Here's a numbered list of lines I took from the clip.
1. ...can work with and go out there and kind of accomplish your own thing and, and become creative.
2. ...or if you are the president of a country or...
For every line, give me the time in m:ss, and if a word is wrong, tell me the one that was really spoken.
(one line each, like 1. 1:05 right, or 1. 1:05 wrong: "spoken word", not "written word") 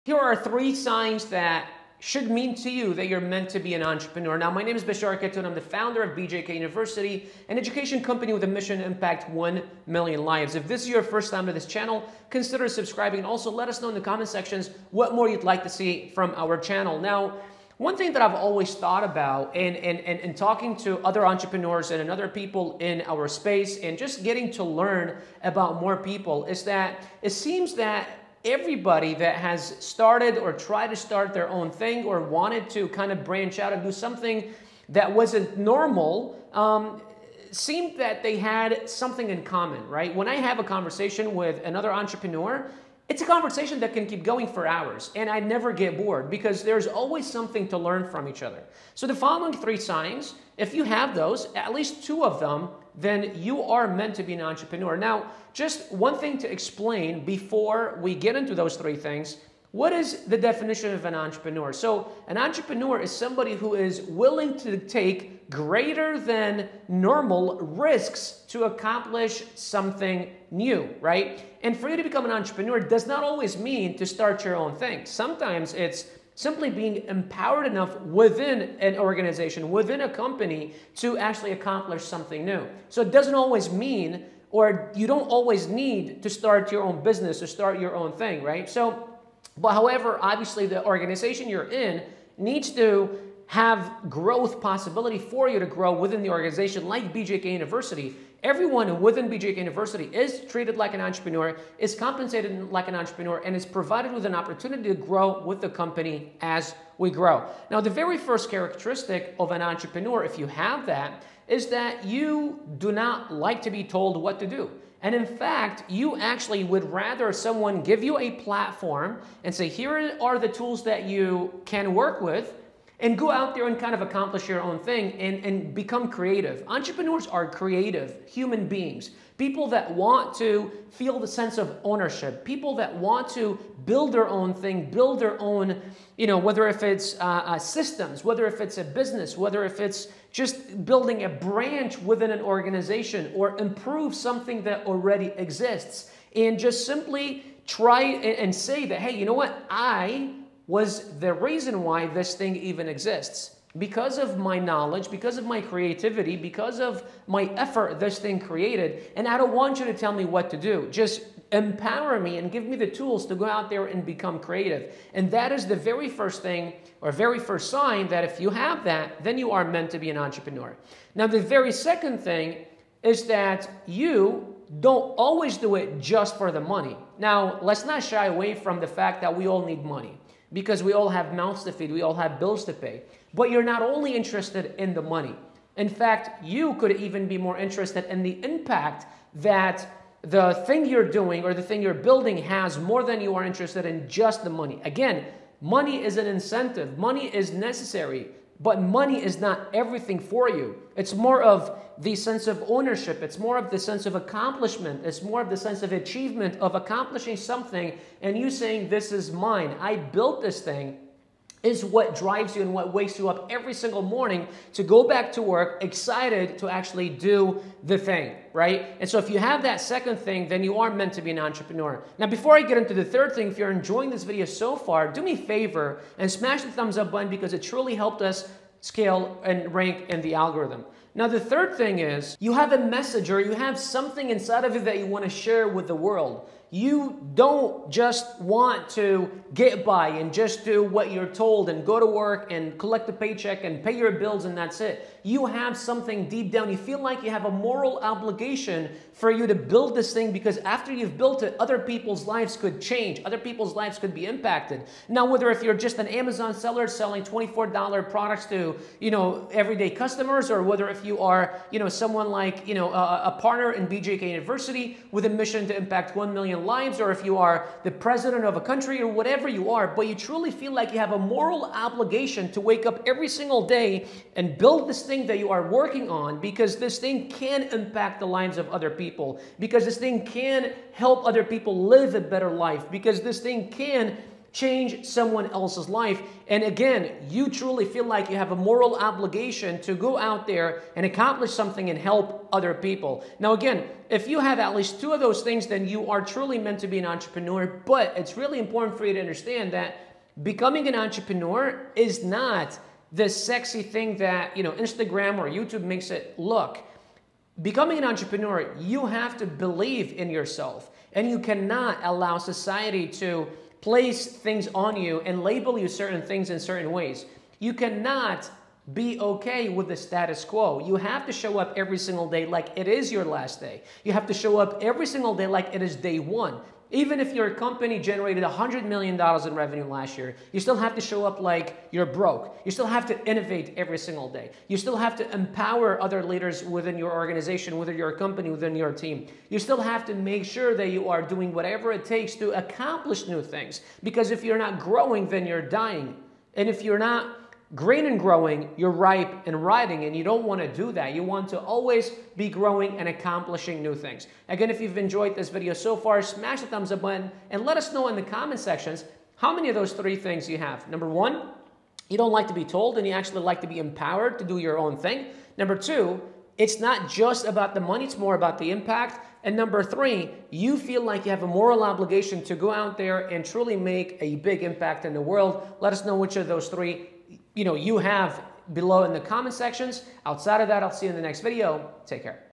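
1. 2:01 right
2. 4:26 right.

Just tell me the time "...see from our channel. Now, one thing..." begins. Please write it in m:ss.
0:15.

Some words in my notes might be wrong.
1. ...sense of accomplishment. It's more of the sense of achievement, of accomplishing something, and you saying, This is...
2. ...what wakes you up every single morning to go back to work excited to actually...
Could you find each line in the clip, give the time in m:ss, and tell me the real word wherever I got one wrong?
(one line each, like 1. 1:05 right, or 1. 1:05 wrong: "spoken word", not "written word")
1. 3:23 right
2. 3:32 right.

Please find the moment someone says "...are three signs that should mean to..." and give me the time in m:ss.
0:00.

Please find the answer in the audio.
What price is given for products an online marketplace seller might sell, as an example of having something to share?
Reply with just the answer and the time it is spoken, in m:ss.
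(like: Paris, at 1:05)
$24, at 4:17.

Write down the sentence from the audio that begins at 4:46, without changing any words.
And again, you truly feel like you have a moral obligation to go out there and accomplish something and help other people.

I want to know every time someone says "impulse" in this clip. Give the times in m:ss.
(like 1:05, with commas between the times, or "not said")
not said.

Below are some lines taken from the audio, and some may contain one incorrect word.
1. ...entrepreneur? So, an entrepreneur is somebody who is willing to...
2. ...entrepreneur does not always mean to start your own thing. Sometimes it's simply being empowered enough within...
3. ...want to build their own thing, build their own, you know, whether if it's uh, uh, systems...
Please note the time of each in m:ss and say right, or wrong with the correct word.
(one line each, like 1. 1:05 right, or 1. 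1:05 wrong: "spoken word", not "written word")
1. 1:01 right
2. 1:12 right
3. 2:12 right.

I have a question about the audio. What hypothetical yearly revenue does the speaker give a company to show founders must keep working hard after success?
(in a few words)
$100 million.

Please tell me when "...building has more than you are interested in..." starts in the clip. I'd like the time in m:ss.
3:11.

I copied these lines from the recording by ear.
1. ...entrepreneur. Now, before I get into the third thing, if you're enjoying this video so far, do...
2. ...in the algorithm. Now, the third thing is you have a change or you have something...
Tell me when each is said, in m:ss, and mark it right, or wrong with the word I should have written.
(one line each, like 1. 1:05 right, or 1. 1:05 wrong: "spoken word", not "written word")
1. 3:41 right
2. 3:50 wrong: "message", not "change".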